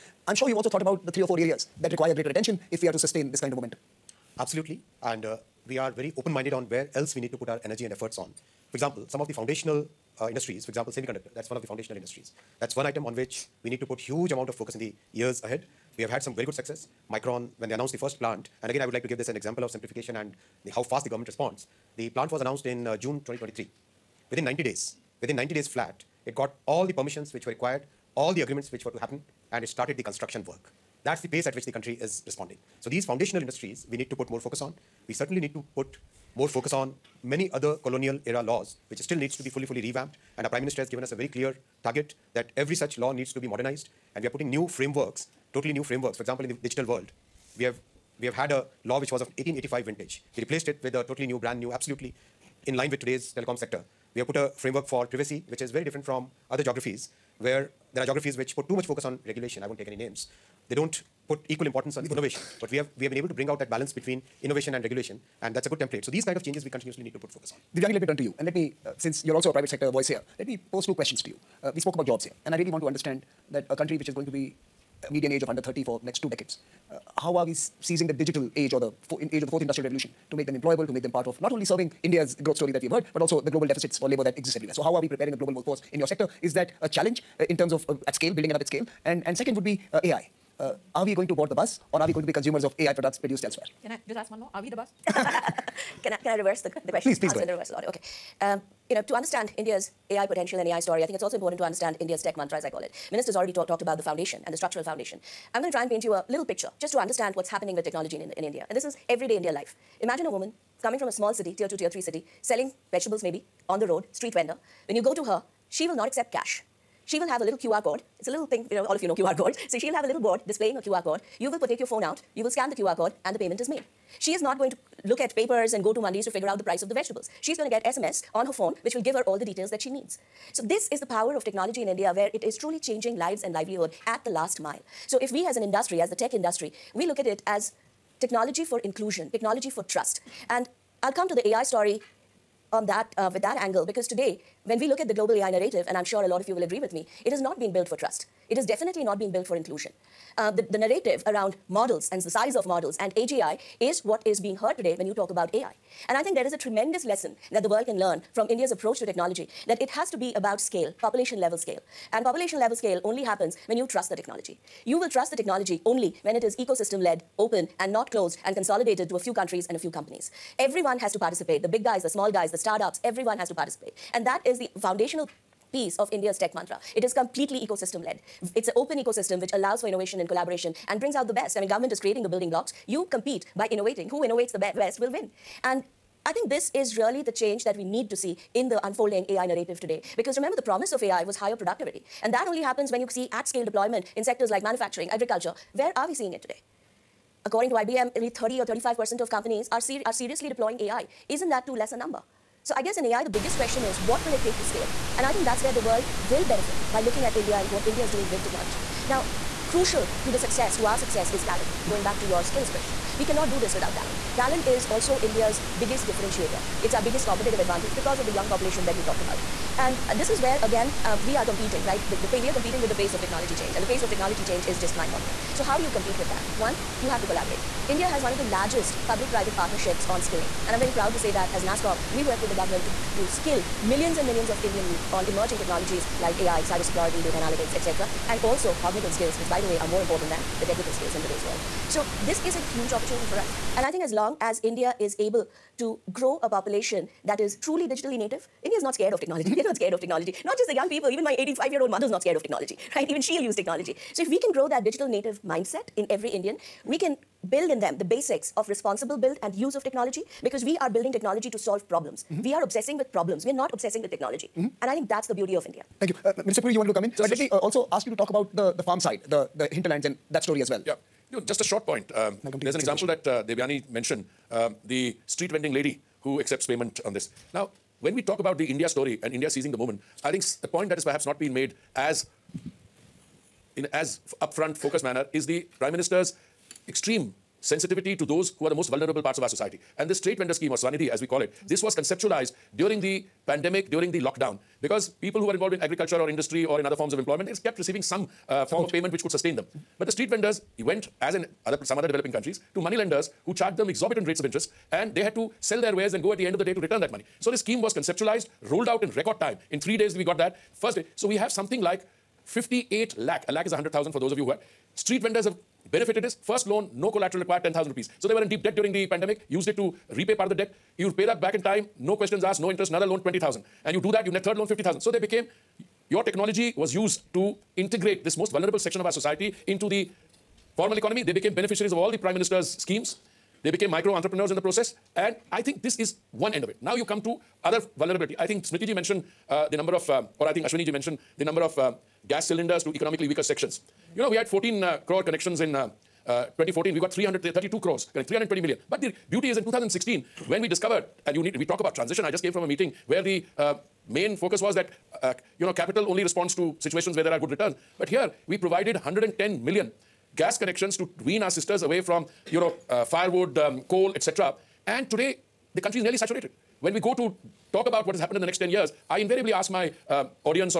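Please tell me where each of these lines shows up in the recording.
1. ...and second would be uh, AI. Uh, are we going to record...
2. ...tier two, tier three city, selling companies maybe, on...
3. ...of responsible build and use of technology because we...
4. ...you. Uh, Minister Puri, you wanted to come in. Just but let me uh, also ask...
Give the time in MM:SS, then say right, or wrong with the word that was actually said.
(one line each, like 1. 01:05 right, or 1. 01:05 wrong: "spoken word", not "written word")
1. 01:29 wrong: "board", not "record"
2. 01:51 wrong: "vegetables", not "companies"
3. 04:18 right
4. 04:26 right.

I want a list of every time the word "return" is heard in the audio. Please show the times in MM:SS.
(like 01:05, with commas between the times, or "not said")
05:06, 05:57.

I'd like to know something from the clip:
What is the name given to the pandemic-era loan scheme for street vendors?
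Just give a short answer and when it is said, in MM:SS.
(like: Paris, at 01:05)
Swanidhi, at 04:50.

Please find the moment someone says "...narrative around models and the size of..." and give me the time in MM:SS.
02:30.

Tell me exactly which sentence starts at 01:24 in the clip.
So how are we preparing a global workforce in your sector?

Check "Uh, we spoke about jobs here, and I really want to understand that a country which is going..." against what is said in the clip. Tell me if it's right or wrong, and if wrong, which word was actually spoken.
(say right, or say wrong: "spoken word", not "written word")
right.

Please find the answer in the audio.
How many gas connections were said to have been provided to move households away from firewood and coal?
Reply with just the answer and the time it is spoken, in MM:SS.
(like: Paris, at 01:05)
110 million, at 05:58.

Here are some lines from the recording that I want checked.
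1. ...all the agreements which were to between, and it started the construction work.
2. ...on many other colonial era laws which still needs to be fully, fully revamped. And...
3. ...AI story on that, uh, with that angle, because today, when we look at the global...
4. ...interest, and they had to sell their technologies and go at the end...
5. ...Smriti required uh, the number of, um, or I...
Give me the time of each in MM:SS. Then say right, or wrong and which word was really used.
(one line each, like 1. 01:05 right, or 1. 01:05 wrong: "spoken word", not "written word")
1. 00:28 wrong: "happen", not "between"
2. 00:36 right
3. 02:21 right
4. 05:04 wrong: "wares", not "technologies"
5. 05:38 wrong: "mentioned", not "required".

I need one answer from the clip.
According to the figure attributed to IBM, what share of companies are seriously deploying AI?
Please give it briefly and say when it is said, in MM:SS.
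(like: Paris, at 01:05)
30 or 35 percent, at 03:18.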